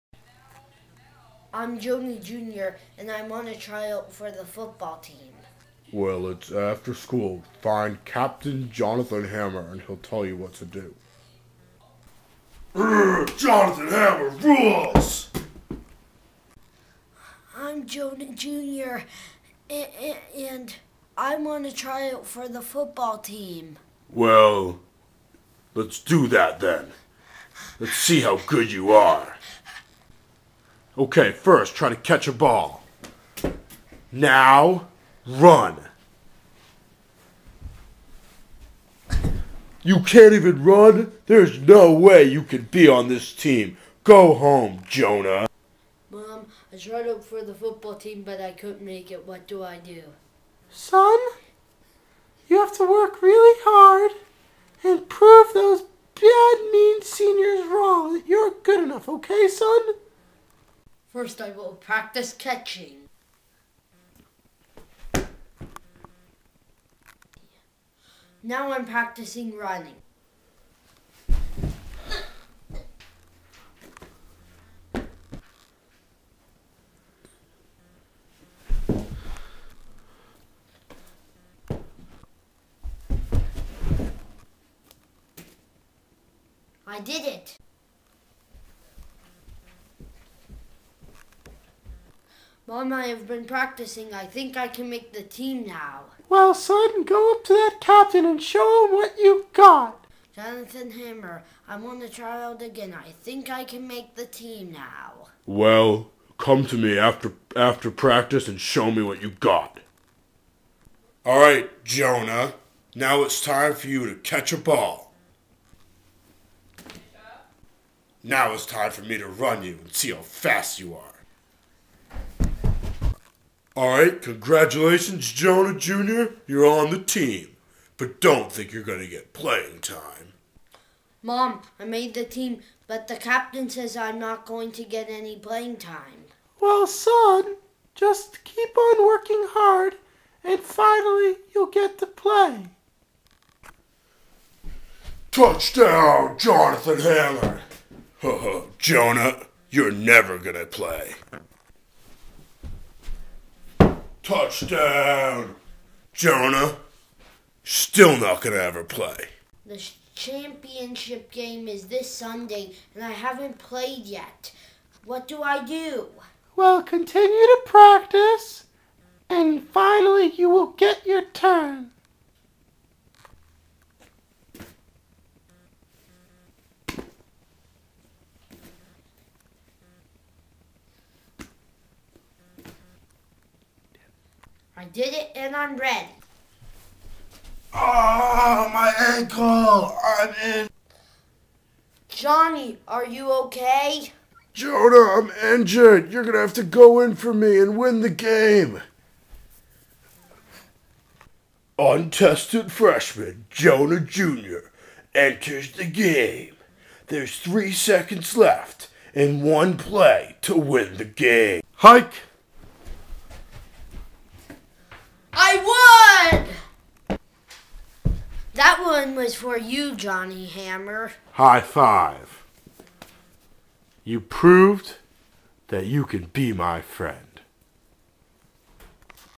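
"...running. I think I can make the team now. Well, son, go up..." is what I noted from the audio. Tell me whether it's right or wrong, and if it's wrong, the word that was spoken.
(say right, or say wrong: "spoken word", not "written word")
wrong: "practicing", not "running".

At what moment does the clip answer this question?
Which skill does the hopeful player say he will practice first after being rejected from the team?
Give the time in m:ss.
1:02.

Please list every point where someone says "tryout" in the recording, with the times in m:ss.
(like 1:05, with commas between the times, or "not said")
0:03, 0:21, 1:42.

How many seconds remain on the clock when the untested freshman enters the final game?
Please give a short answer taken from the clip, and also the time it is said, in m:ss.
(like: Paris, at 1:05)
3, at 3:27.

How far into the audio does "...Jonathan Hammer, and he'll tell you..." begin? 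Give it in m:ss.
0:08.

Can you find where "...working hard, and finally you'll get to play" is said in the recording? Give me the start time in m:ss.
2:19.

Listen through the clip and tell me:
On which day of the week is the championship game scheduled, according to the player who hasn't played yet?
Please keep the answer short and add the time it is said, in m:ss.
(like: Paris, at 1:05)
Sunday, at 2:41.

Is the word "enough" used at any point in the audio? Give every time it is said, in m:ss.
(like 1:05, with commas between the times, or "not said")
0:58.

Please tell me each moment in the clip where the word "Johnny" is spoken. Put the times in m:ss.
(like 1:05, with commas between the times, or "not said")
3:12, 3:39.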